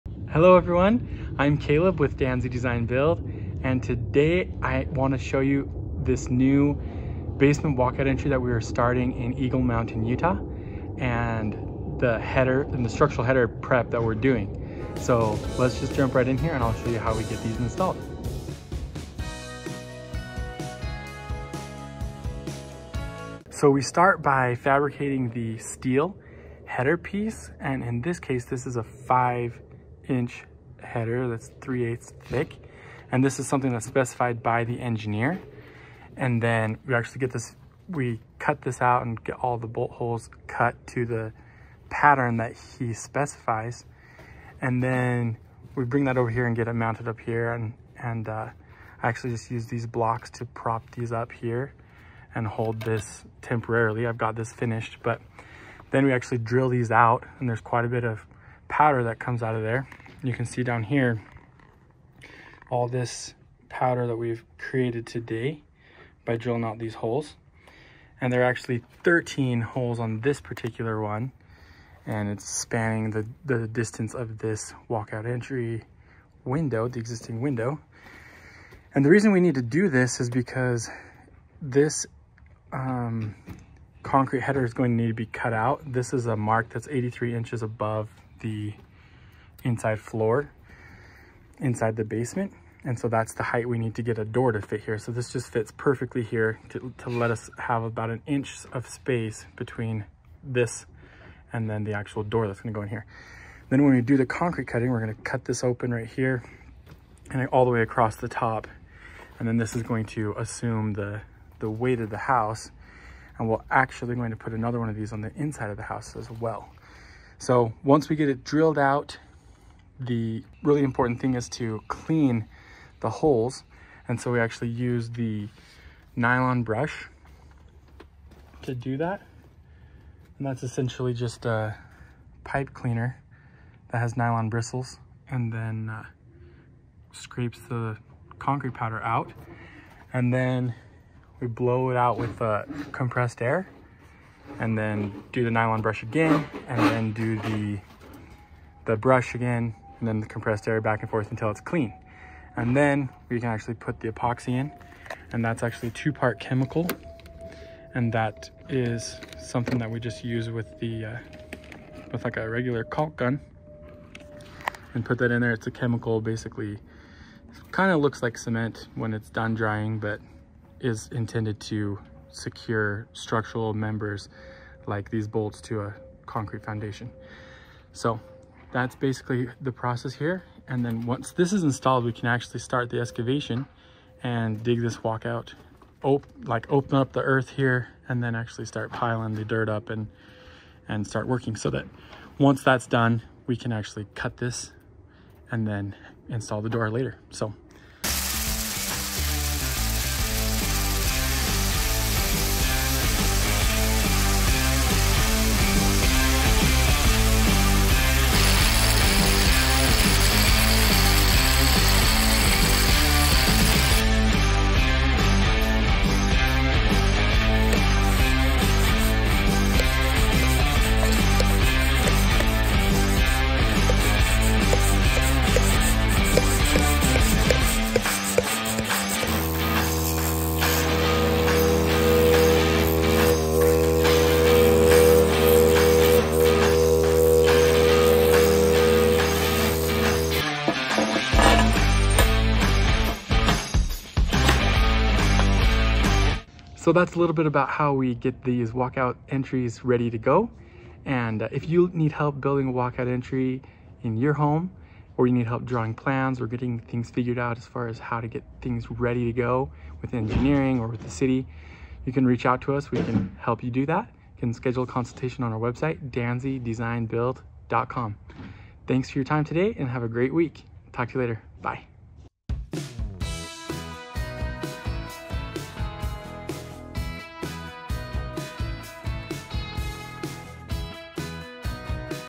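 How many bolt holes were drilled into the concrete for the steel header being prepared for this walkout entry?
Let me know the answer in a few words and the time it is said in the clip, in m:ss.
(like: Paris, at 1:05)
13, at 1:09.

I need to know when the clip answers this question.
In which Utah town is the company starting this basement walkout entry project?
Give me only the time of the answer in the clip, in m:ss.
0:09.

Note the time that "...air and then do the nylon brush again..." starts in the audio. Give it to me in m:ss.
2:23.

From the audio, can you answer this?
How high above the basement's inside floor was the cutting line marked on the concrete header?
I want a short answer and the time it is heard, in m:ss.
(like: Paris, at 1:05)
83 inches, at 1:26.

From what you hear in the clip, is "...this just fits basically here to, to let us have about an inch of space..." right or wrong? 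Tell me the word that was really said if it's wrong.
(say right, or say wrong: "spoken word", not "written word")
wrong: "perfectly", not "basically".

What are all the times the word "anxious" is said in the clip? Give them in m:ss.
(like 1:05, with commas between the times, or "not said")
not said.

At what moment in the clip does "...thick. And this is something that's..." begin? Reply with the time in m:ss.
0:32.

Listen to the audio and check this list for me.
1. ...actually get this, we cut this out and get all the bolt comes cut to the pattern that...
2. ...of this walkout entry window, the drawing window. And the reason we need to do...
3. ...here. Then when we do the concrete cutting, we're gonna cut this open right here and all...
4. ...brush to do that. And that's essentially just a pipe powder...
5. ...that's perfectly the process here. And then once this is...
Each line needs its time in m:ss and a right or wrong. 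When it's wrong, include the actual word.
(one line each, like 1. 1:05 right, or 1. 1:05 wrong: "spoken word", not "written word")
1. 0:36 wrong: "holes", not "comes"
2. 1:14 wrong: "existing", not "drawing"
3. 1:42 right
4. 2:06 wrong: "cleaner", not "powder"
5. 2:58 wrong: "basically", not "perfectly".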